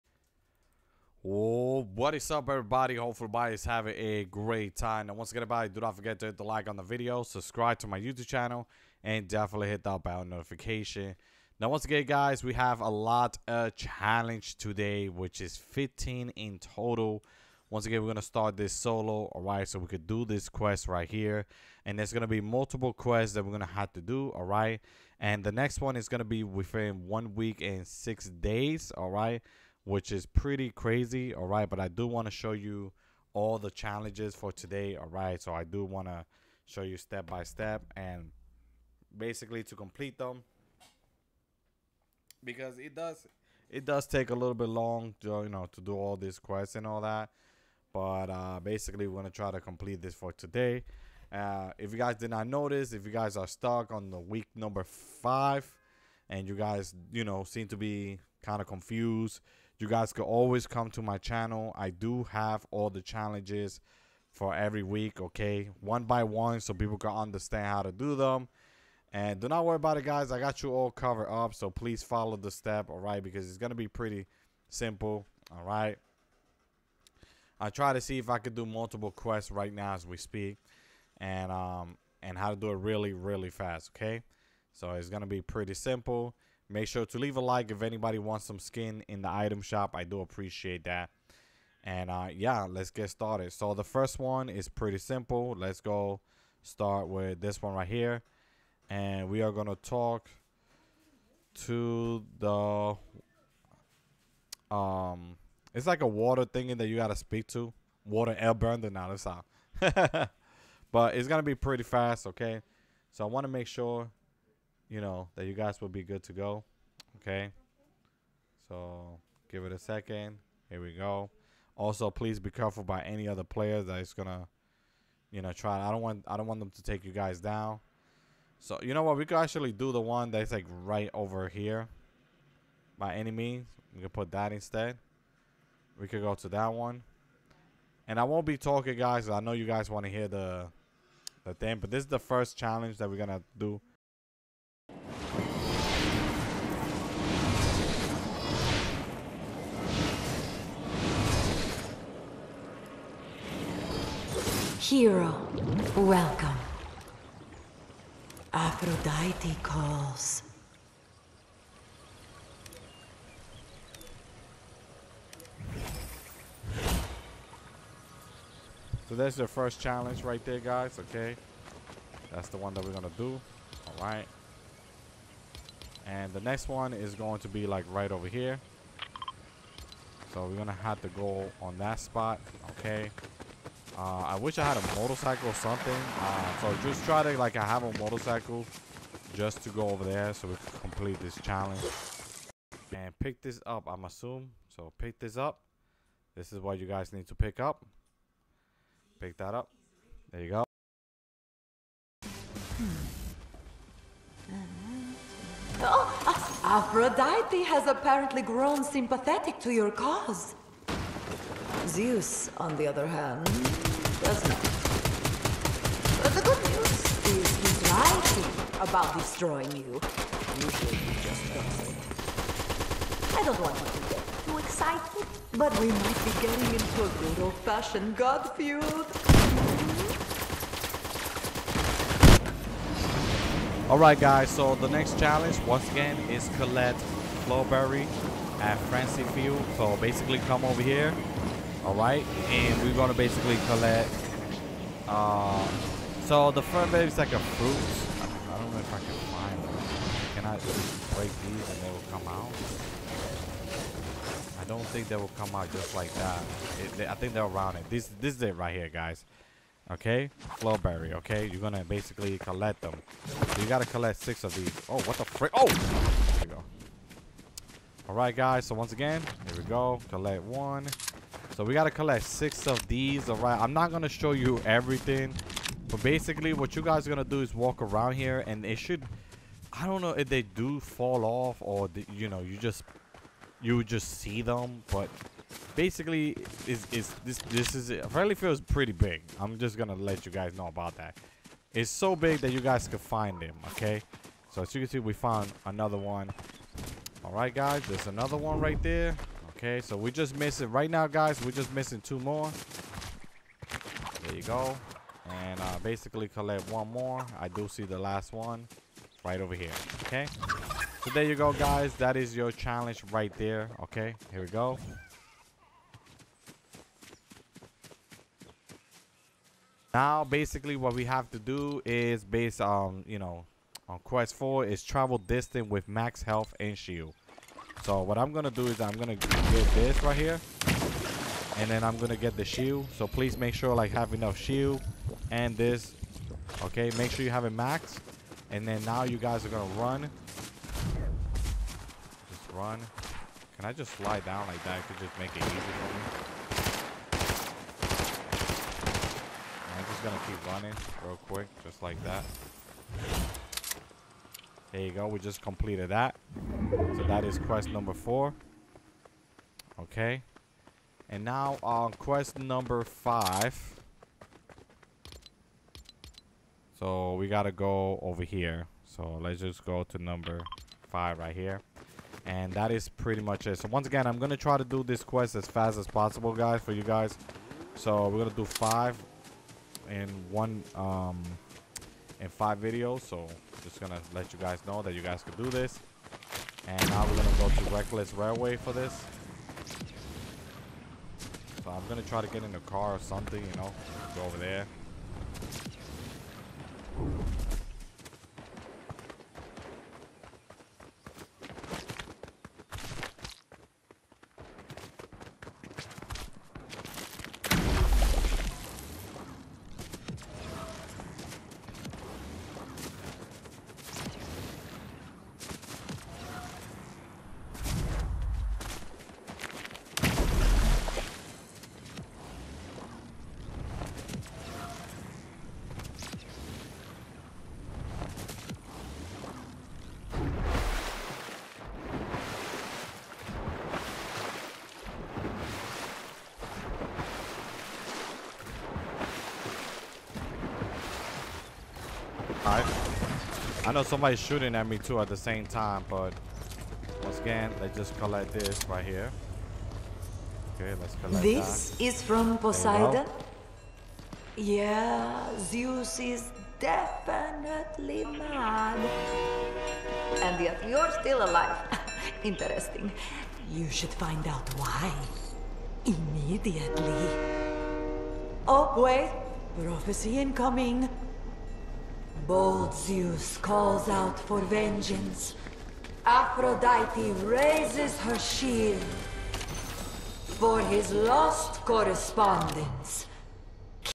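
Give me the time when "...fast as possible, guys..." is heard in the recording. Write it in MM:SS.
06:15.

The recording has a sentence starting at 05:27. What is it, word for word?
So what I'm going to do is I'm going to get this right here.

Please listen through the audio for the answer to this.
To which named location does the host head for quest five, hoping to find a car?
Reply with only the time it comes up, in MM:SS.
06:27.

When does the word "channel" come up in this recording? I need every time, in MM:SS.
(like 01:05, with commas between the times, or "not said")
00:08, 01:01.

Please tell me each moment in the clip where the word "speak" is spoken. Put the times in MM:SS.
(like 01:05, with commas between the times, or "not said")
01:20, 01:47.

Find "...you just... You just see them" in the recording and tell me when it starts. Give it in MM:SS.
04:42.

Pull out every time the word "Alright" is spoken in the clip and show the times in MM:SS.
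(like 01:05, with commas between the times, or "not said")
03:53, 07:22.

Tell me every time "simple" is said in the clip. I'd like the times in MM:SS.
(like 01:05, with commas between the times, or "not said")
01:14, 01:25, 01:34.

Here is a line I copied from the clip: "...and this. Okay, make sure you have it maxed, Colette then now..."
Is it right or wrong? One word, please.
wrong.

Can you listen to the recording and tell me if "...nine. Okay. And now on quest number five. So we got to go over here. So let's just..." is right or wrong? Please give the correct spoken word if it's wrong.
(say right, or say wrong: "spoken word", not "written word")
wrong: "four", not "nine".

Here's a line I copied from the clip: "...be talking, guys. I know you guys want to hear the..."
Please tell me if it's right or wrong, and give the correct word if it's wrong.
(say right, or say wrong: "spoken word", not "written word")
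right.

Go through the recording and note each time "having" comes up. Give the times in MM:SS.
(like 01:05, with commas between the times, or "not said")
00:03.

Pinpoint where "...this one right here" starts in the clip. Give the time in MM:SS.
01:37.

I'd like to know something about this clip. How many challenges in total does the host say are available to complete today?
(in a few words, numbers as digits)
15.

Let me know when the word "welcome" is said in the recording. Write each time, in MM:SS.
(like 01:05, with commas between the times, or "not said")
02:35.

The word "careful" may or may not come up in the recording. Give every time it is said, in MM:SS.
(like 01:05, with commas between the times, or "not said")
02:02.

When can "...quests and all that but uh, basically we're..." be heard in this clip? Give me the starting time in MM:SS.
00:46.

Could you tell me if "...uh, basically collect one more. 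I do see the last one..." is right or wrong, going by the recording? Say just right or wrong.
right.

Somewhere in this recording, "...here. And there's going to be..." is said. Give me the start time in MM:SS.
00:21.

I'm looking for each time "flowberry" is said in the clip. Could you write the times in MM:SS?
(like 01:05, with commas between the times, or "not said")
03:57, 04:20.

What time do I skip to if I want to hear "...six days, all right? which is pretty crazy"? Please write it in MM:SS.
00:27.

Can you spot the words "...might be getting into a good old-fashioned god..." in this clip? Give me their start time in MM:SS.
03:45.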